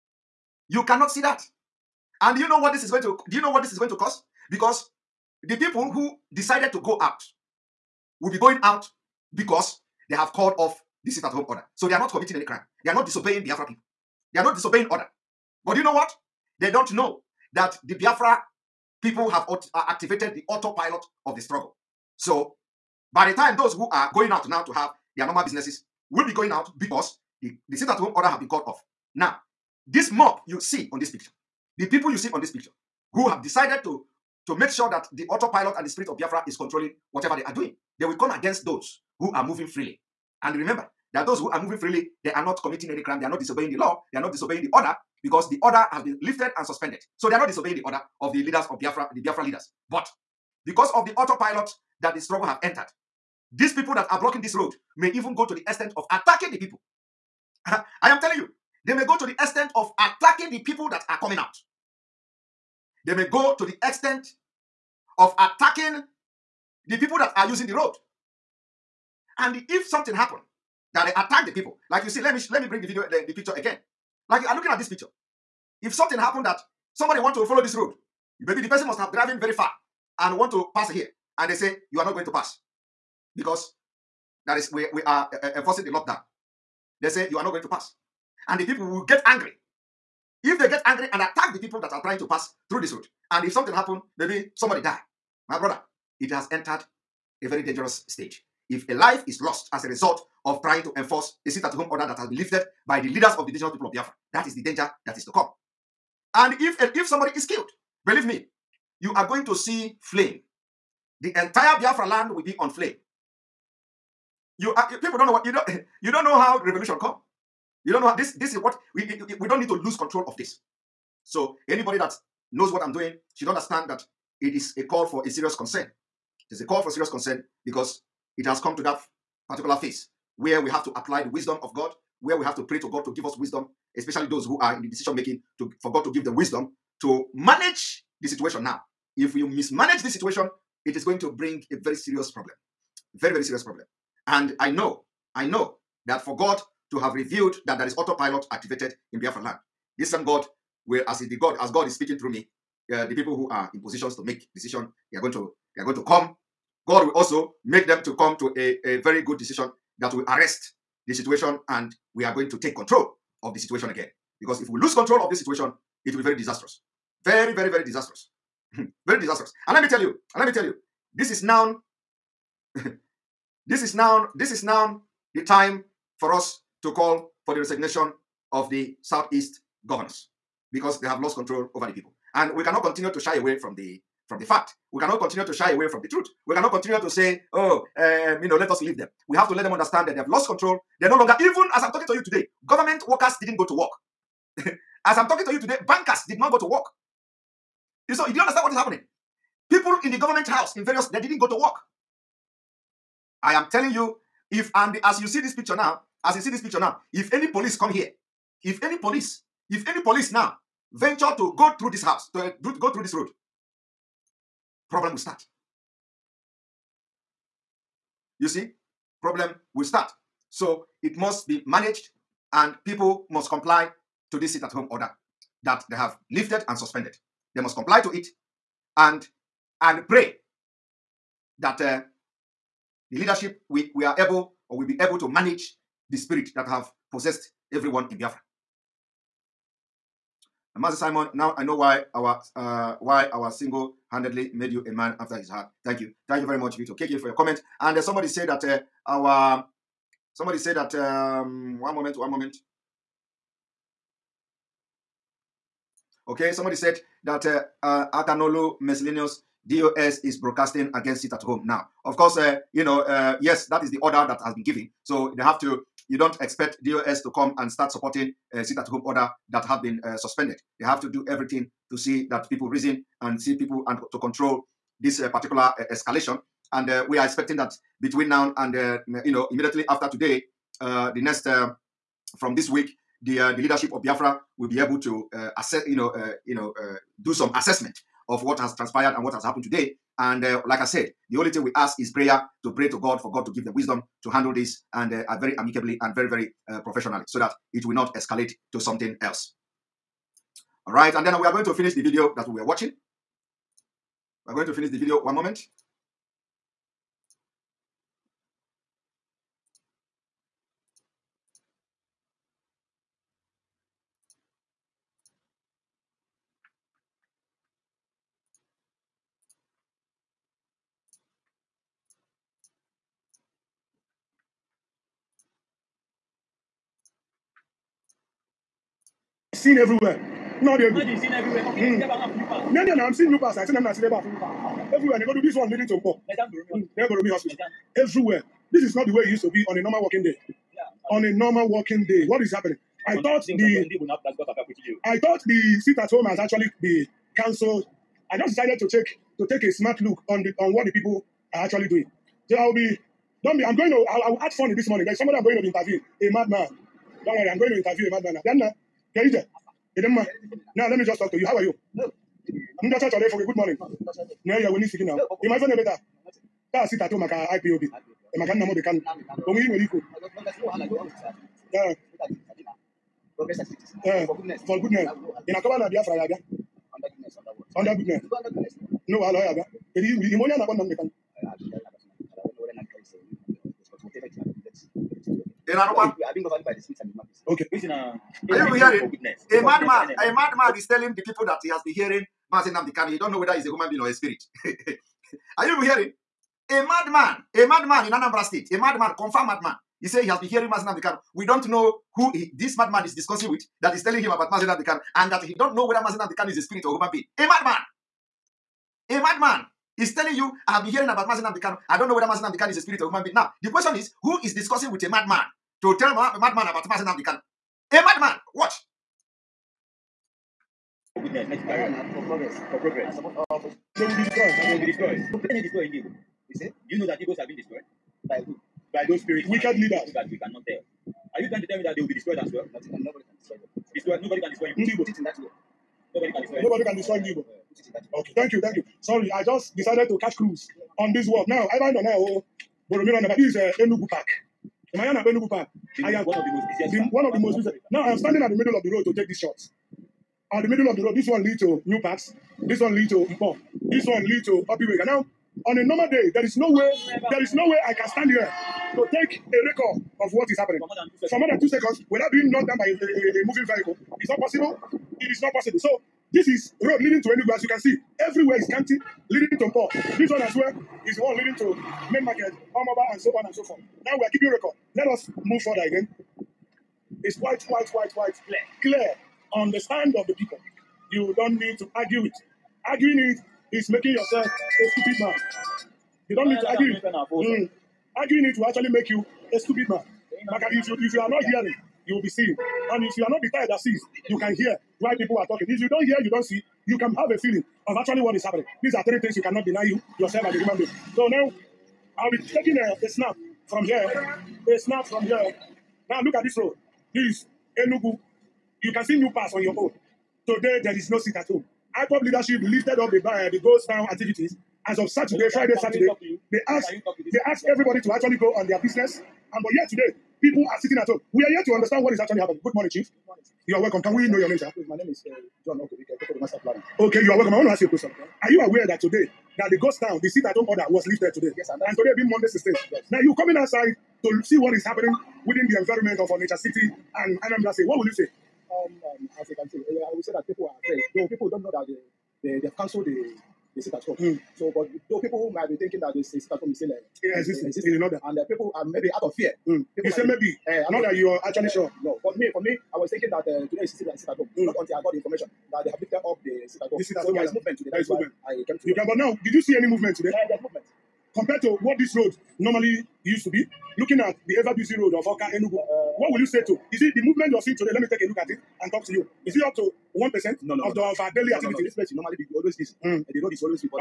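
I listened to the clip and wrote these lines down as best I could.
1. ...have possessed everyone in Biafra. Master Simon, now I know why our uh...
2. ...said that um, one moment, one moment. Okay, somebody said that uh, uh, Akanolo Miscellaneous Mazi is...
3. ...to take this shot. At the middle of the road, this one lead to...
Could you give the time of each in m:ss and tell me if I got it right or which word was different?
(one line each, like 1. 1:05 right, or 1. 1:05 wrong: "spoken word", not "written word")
1. 3:56 right
2. 4:10 wrong: "DOS", not "Mazi"
3. 7:29 right.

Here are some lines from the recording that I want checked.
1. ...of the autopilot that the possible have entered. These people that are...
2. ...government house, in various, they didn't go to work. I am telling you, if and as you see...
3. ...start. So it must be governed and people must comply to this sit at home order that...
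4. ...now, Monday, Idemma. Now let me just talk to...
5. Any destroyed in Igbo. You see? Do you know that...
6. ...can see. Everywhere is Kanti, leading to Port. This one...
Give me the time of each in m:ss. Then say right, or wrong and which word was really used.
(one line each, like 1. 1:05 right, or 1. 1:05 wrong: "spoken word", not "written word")
1. 0:50 wrong: "struggle", not "possible"
2. 3:20 right
3. 3:39 wrong: "managed", not "governed"
4. 5:58 wrong: "Keija", not "Monday"
5. 7:05 right
6. 7:47 right.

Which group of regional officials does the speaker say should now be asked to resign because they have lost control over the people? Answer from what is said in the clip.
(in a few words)
Southeast governors.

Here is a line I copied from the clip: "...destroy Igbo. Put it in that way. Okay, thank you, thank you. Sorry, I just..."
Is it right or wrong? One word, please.
right.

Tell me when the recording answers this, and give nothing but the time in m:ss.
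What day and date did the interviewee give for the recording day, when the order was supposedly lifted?
8:52.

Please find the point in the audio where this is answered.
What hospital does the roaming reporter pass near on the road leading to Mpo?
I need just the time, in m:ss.
5:36.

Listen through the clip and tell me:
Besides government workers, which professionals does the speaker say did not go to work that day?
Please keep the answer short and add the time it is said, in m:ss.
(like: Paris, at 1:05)
bankers, at 3:15.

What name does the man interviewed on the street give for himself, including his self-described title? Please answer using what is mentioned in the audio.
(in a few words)
John Okobike.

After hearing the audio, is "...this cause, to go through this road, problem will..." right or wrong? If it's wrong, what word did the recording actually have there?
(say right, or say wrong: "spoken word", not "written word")
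wrong: "house", not "cause".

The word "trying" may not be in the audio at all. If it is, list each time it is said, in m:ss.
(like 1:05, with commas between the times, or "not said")
1:32, 1:40, 7:11.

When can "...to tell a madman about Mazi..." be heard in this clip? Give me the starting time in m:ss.
6:55.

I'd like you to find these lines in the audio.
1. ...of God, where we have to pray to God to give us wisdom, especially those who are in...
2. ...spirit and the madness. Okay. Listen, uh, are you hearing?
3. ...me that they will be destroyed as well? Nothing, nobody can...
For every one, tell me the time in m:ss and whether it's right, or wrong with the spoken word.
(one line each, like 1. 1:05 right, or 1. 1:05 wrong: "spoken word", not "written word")
1. 2:11 right
2. 6:26 right
3. 7:11 right.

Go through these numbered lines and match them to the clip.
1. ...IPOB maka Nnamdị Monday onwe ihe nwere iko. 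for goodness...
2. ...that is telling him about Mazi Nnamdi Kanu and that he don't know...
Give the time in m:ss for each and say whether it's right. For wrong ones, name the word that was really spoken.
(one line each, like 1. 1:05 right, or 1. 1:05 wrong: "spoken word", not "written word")
1. 6:07 wrong: "Kanụ", not "Monday"
2. 6:43 right.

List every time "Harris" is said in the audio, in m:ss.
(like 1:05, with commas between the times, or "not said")
not said.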